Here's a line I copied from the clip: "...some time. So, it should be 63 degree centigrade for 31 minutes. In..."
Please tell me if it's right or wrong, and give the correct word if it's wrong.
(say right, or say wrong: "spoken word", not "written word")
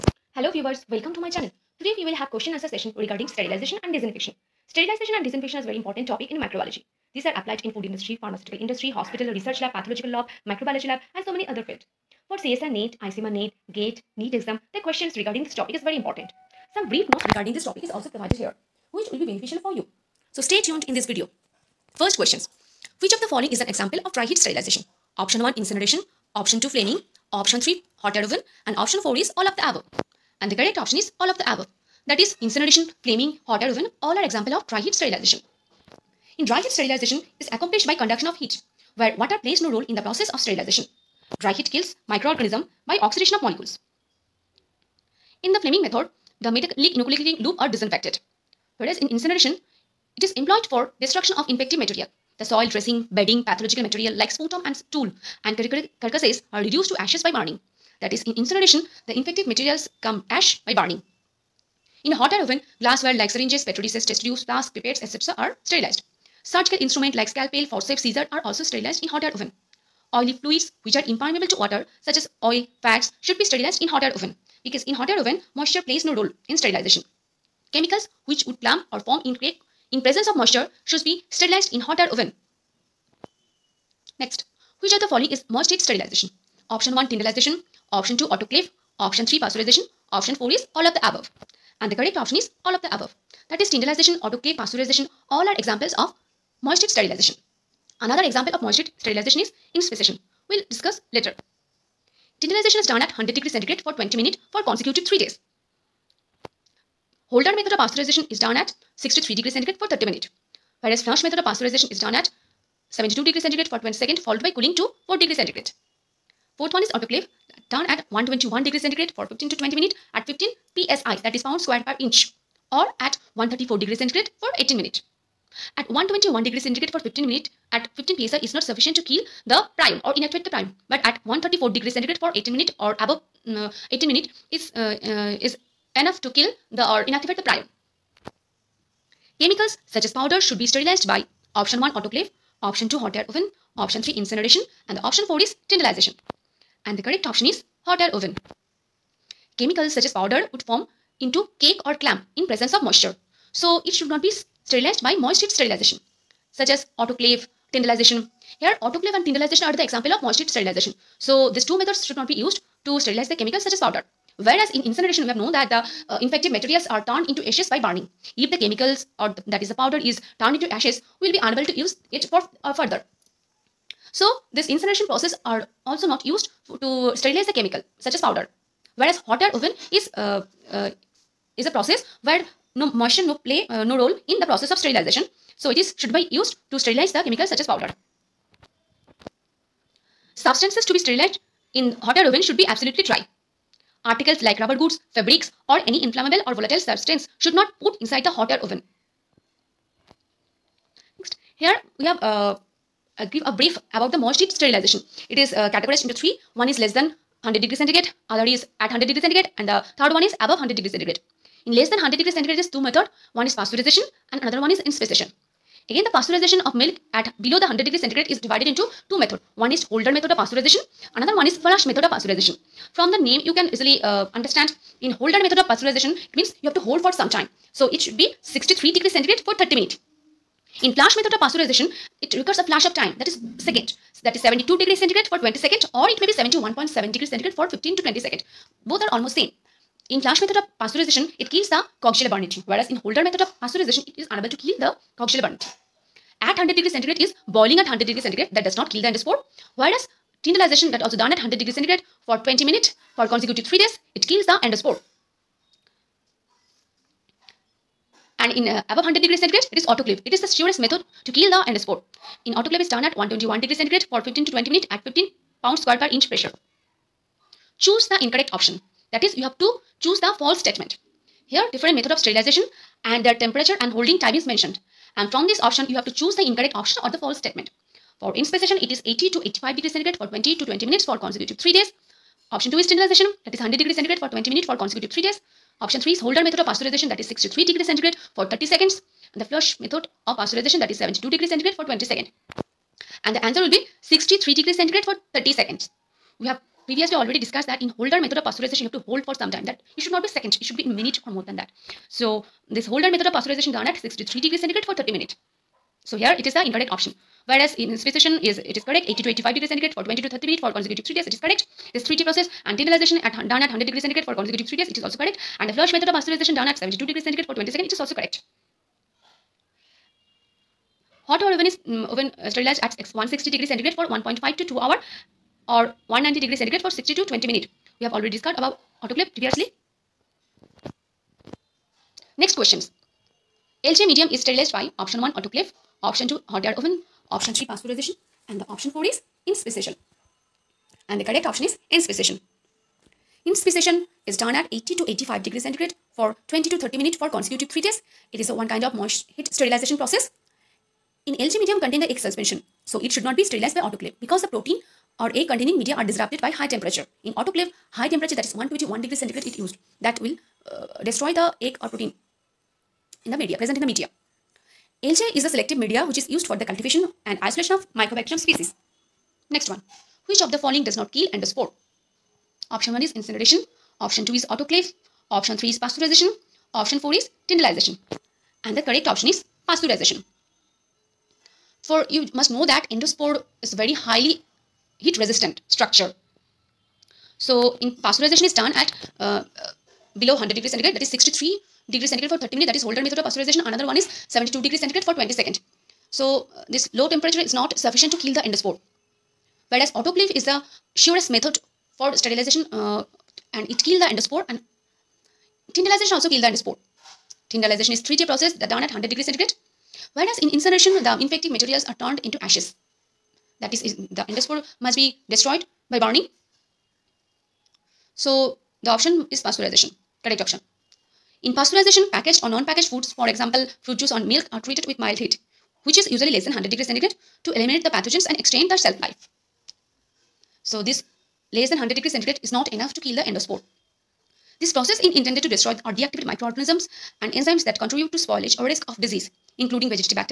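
wrong: "30", not "31".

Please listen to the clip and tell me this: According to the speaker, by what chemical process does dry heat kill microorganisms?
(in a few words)
Oxidation of molecules.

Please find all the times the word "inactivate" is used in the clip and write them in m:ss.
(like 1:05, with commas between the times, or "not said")
2:10, 2:17.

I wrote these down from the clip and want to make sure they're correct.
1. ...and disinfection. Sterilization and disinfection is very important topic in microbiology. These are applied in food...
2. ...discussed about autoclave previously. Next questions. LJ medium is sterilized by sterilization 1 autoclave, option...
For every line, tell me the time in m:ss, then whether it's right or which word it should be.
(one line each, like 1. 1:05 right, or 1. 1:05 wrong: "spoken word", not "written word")
1. 0:03 right
2. 5:28 wrong: "option", not "sterilization".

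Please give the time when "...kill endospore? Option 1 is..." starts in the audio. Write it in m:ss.
6:11.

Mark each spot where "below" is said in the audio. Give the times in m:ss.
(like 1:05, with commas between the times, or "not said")
3:37, 6:30.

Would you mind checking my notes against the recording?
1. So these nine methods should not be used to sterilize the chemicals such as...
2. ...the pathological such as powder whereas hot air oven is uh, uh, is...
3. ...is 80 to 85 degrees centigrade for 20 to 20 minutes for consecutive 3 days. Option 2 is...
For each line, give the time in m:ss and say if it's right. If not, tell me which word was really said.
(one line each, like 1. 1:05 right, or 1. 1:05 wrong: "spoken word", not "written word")
1. 2:41 wrong: "two", not "nine"
2. 2:57 wrong: "chemical", not "pathological"
3. 4:38 right.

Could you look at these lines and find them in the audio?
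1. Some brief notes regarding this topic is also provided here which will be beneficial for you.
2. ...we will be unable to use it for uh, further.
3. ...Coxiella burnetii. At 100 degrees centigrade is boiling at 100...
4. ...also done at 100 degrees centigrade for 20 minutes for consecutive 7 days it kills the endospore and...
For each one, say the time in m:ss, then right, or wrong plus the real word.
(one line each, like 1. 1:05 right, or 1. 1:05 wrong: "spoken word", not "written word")
1. 0:16 right
2. 2:51 right
3. 4:05 right
4. 4:11 wrong: "3", not "7".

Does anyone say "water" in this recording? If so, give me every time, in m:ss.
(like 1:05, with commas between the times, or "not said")
0:39, 1:11.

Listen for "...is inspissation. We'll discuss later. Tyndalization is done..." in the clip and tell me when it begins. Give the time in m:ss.
1:39.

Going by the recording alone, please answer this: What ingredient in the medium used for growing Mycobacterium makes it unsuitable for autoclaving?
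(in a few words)
Egg suspension.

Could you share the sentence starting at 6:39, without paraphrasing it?
Whereas autoclave is the surest method for sterilization uh, and it kills the endospore and tyndalization also kills the endospore.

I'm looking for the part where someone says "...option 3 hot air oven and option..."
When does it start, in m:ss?
0:27.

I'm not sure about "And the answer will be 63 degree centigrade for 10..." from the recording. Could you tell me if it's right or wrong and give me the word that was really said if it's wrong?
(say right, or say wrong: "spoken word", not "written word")
wrong: "30", not "10".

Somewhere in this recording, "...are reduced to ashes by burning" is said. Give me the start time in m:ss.
0:56.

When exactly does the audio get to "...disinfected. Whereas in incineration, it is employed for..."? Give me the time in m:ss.
0:47.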